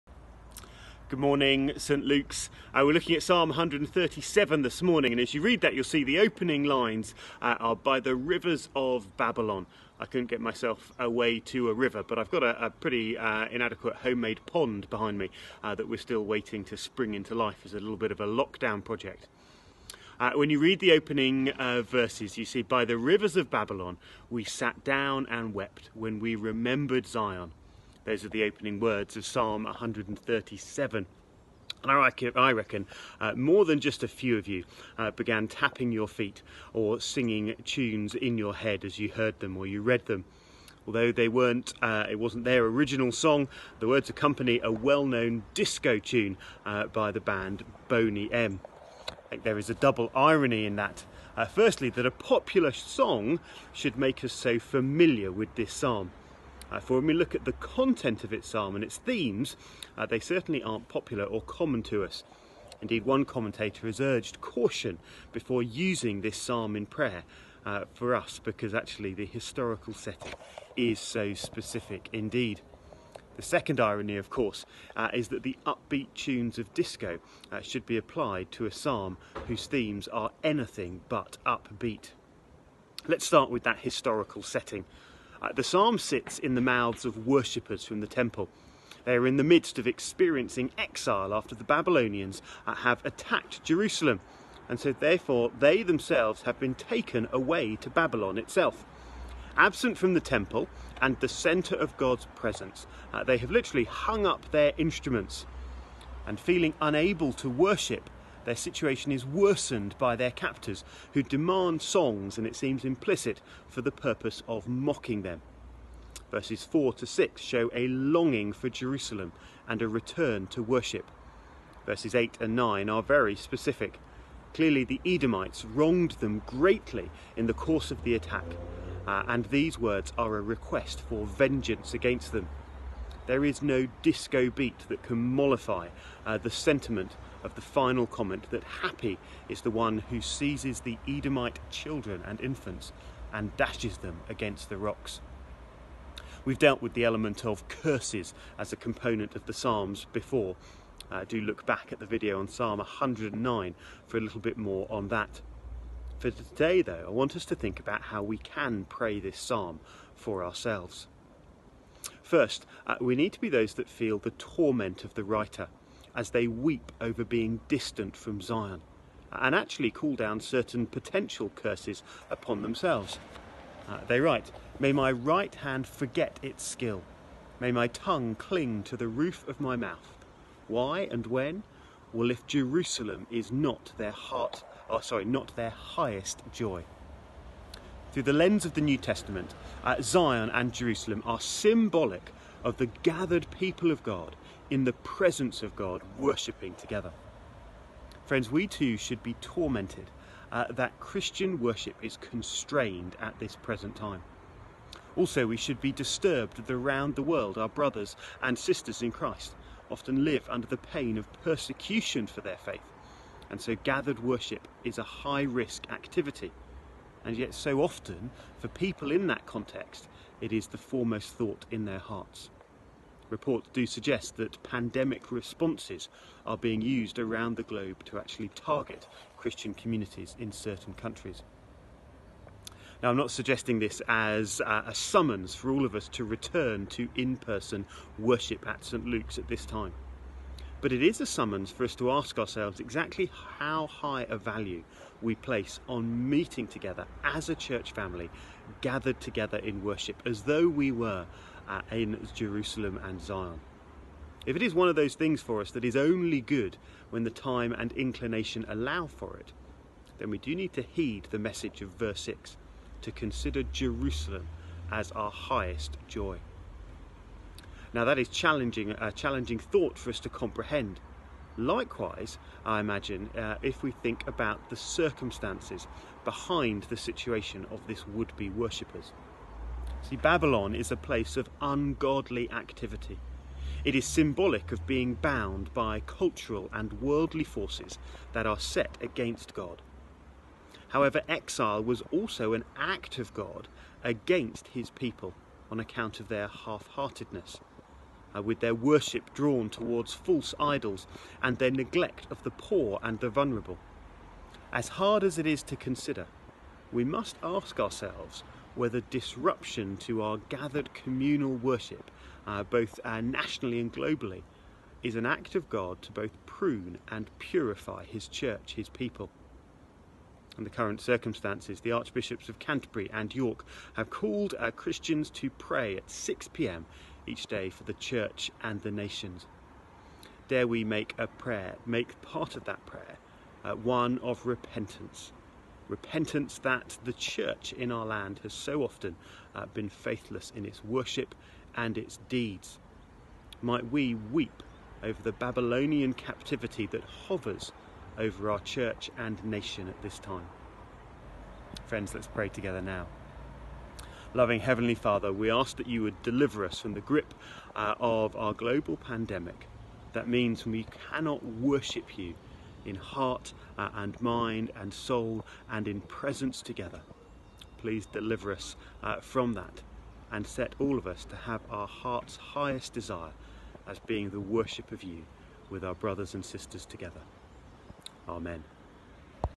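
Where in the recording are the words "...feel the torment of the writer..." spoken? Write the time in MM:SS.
02:43.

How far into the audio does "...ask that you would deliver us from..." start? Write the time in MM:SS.
05:55.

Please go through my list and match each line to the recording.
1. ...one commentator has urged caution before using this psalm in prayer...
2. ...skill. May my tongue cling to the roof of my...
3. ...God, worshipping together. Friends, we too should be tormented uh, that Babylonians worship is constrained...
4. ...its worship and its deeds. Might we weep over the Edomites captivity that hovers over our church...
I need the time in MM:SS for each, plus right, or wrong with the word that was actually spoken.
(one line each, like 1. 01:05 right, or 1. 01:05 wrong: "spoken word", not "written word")
1. 01:03 right
2. 02:56 right
3. 03:15 wrong: "Christian", not "Babylonians"
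4. 05:40 wrong: "Babylonian", not "Edomites".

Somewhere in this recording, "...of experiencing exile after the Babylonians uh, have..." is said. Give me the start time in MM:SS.
01:29.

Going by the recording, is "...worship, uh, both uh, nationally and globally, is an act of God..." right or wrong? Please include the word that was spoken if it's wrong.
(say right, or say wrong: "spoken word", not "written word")
right.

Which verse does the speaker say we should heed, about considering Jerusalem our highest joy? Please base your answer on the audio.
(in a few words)
verse 6.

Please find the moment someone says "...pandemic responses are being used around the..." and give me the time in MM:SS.
03:44.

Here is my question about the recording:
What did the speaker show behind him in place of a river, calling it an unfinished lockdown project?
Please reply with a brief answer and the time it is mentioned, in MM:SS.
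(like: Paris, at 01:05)
homemade pond, at 00:13.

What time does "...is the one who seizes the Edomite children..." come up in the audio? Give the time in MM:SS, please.
02:19.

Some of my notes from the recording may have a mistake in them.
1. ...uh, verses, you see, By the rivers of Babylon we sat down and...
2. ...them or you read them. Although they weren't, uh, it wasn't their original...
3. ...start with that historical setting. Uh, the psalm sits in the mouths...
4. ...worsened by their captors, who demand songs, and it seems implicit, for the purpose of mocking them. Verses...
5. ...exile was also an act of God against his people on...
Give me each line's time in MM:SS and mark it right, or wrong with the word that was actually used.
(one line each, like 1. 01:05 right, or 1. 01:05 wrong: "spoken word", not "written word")
1. 00:21 right
2. 00:39 right
3. 01:23 right
4. 01:49 right
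5. 04:51 right.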